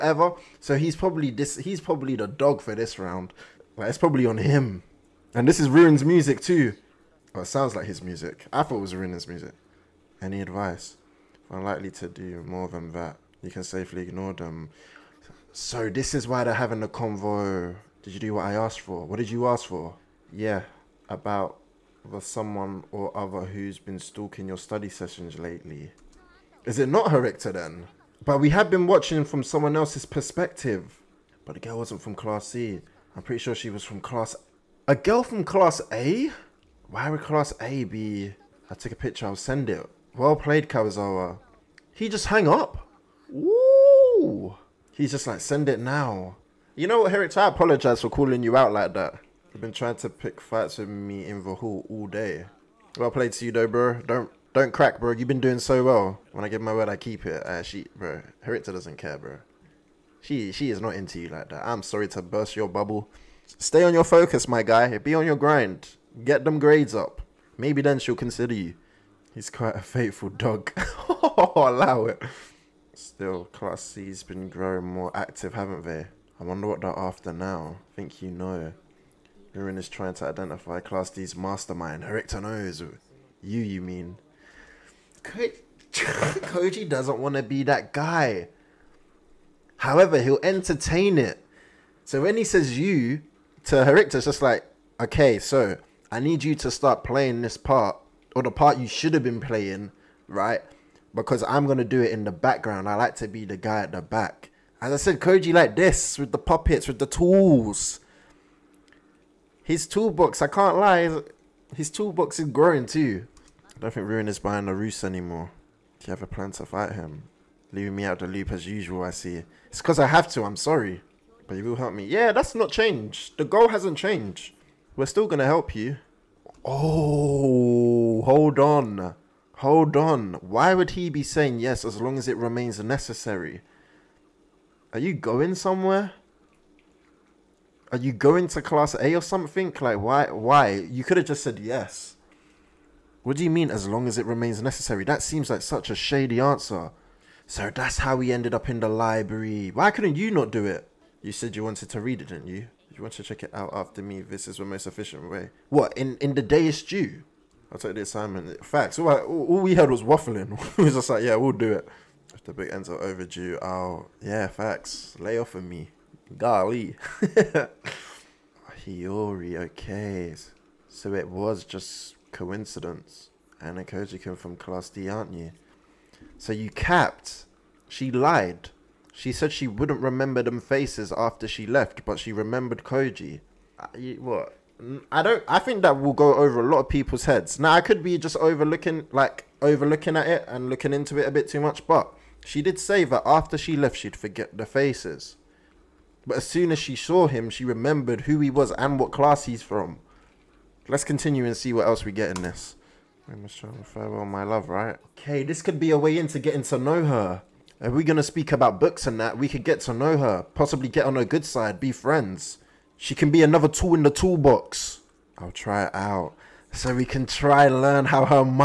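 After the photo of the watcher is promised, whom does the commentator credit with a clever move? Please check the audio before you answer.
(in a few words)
Karuizawa.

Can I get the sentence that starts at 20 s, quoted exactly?
Yeah, about the someone or other who's been stalking your study sessions lately.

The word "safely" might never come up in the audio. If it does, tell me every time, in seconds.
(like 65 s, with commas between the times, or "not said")
13 s.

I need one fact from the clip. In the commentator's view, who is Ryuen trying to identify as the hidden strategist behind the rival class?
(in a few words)
Class D's mastermind.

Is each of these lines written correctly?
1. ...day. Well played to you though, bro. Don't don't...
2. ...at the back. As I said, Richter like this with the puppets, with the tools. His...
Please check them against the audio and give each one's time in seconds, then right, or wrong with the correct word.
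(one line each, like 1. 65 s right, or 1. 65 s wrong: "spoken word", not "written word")
1. 52 s right
2. 103 s wrong: "Koji", not "Richter".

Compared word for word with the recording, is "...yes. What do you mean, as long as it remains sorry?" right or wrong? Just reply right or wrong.
wrong.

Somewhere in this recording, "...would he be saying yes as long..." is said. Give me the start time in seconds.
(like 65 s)
130 s.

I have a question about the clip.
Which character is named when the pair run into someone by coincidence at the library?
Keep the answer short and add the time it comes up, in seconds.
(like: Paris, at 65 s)
Hiyori, at 168 s.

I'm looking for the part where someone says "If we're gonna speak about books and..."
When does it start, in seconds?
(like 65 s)
207 s.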